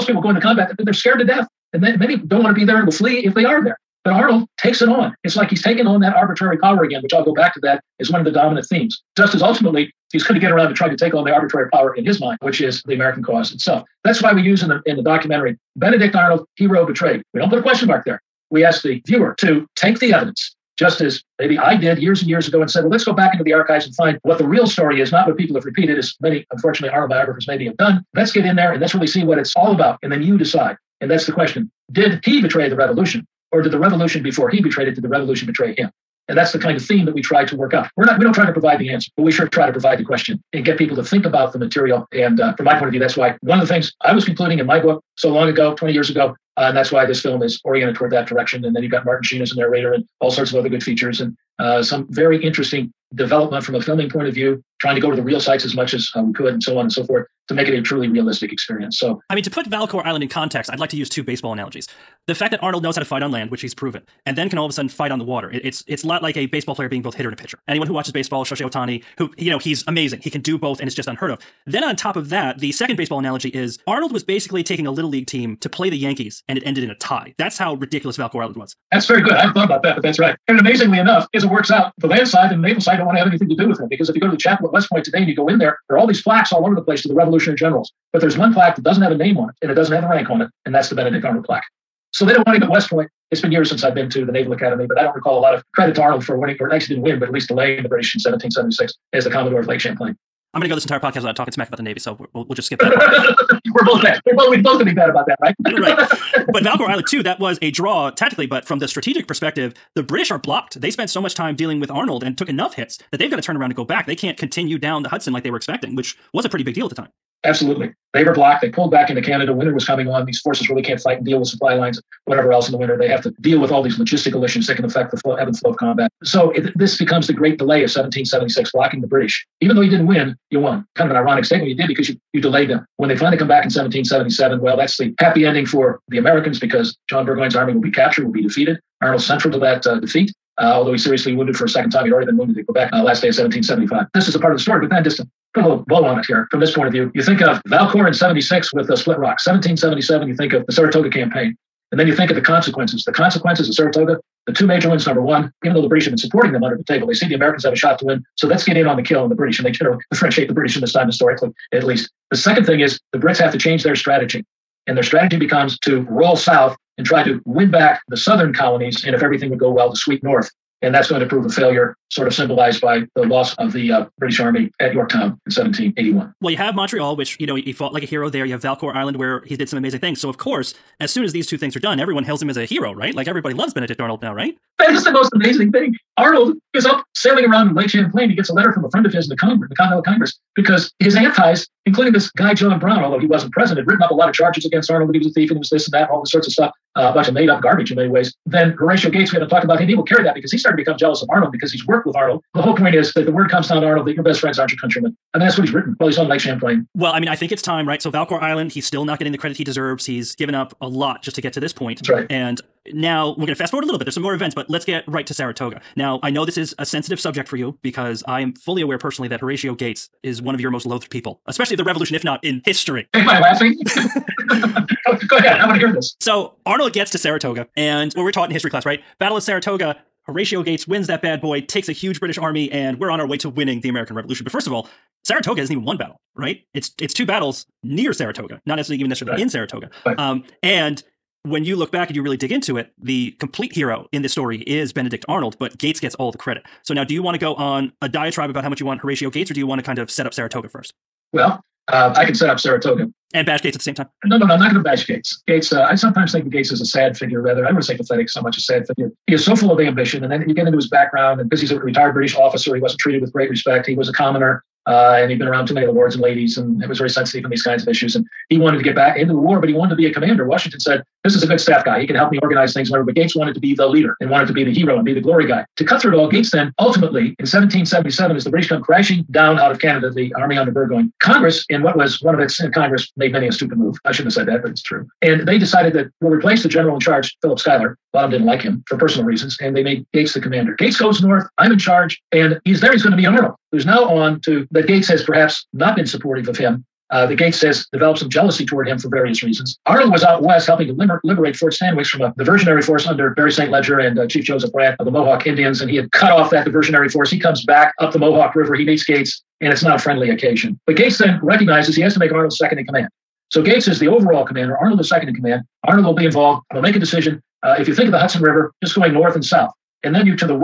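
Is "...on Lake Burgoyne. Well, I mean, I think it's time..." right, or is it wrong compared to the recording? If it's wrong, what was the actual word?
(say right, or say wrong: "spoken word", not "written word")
wrong: "Champlain", not "Burgoyne".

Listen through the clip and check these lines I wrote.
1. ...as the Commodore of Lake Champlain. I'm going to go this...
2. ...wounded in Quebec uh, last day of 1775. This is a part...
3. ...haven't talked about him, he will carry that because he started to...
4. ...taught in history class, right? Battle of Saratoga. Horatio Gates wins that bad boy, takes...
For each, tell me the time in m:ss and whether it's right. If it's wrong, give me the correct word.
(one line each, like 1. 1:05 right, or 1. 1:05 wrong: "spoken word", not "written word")
1. 1:39 right
2. 2:22 right
3. 3:19 right
4. 3:48 right.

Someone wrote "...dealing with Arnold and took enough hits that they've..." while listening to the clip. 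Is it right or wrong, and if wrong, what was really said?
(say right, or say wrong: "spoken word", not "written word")
right.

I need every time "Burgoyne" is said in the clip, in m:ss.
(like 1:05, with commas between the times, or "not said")
2:17, 4:40.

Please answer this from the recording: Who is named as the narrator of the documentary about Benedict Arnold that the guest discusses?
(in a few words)
Martin Sheen.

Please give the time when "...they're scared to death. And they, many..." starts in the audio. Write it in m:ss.
0:00.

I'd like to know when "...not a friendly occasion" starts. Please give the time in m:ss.
5:09.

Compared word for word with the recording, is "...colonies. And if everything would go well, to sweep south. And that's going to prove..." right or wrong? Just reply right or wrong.
wrong.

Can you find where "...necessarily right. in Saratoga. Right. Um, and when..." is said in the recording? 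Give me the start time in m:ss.
3:59.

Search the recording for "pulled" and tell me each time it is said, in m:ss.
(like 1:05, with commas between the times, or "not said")
1:58.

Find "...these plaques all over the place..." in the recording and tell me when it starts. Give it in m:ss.
1:26.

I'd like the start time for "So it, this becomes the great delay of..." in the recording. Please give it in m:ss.
2:06.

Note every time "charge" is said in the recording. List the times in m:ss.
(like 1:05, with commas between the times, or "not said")
3:14, 4:46, 4:51.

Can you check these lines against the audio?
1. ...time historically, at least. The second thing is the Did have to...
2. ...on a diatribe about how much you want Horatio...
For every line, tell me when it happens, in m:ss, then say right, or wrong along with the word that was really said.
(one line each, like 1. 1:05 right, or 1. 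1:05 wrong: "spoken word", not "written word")
1. 2:40 wrong: "Brits", not "Did"
2. 4:07 right.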